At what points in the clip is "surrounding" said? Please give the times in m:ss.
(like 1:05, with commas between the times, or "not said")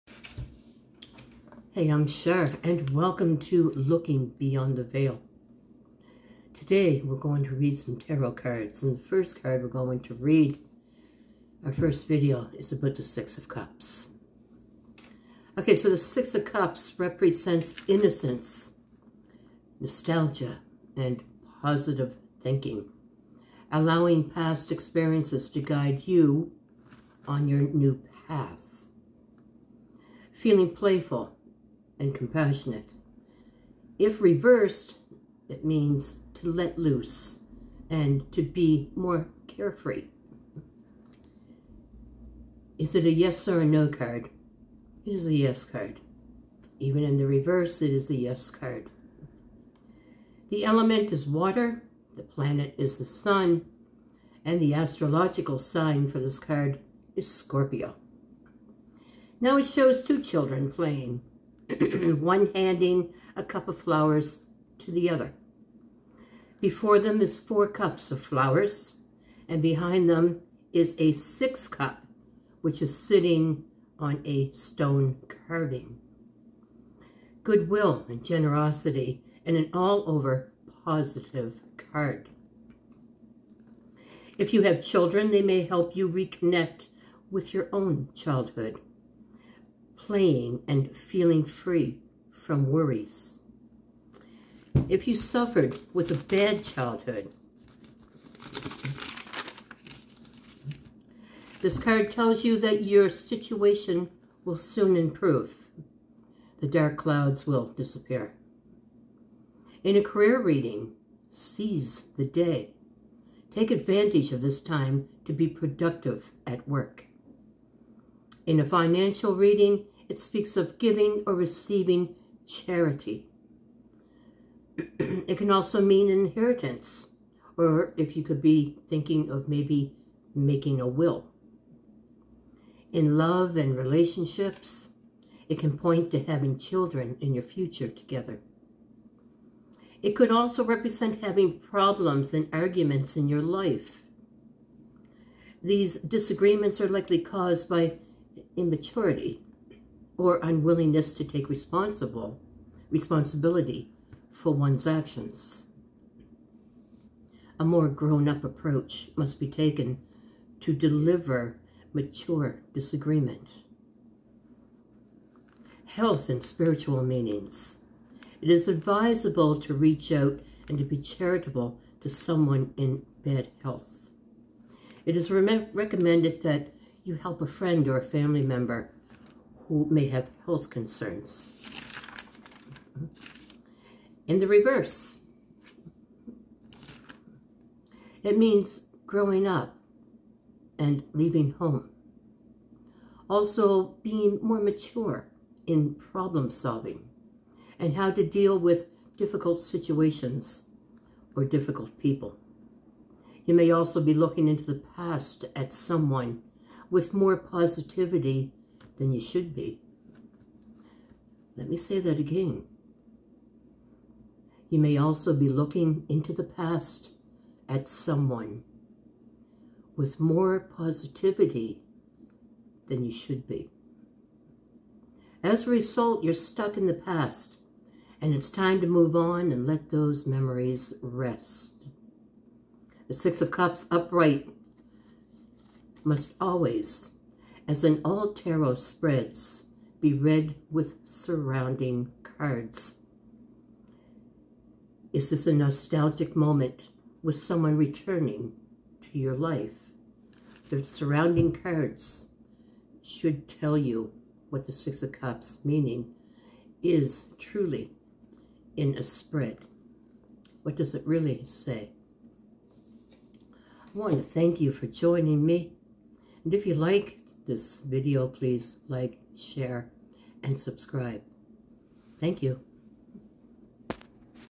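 4:01, 4:10.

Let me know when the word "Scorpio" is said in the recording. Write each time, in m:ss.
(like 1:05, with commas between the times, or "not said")
0:57.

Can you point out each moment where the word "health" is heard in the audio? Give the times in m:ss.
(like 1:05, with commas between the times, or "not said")
2:45, 2:53, 3:00.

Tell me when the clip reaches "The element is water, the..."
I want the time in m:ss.
0:50.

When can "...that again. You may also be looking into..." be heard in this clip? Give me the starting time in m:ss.
3:31.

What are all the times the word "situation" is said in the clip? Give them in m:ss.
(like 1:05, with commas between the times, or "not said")
1:43, 3:19.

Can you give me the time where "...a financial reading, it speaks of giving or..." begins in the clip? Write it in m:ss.
1:58.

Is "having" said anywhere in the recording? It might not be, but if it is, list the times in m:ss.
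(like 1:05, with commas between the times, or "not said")
2:16, 2:21.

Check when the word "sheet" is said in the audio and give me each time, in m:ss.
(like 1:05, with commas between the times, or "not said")
not said.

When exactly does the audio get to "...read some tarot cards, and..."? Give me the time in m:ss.
0:07.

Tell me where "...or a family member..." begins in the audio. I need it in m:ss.
2:57.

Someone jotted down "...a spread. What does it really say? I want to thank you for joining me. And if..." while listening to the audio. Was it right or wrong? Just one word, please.
right.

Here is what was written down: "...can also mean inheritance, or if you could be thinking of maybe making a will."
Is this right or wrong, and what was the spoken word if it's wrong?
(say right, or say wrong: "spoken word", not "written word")
right.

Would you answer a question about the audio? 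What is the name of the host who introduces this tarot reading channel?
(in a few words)
Char.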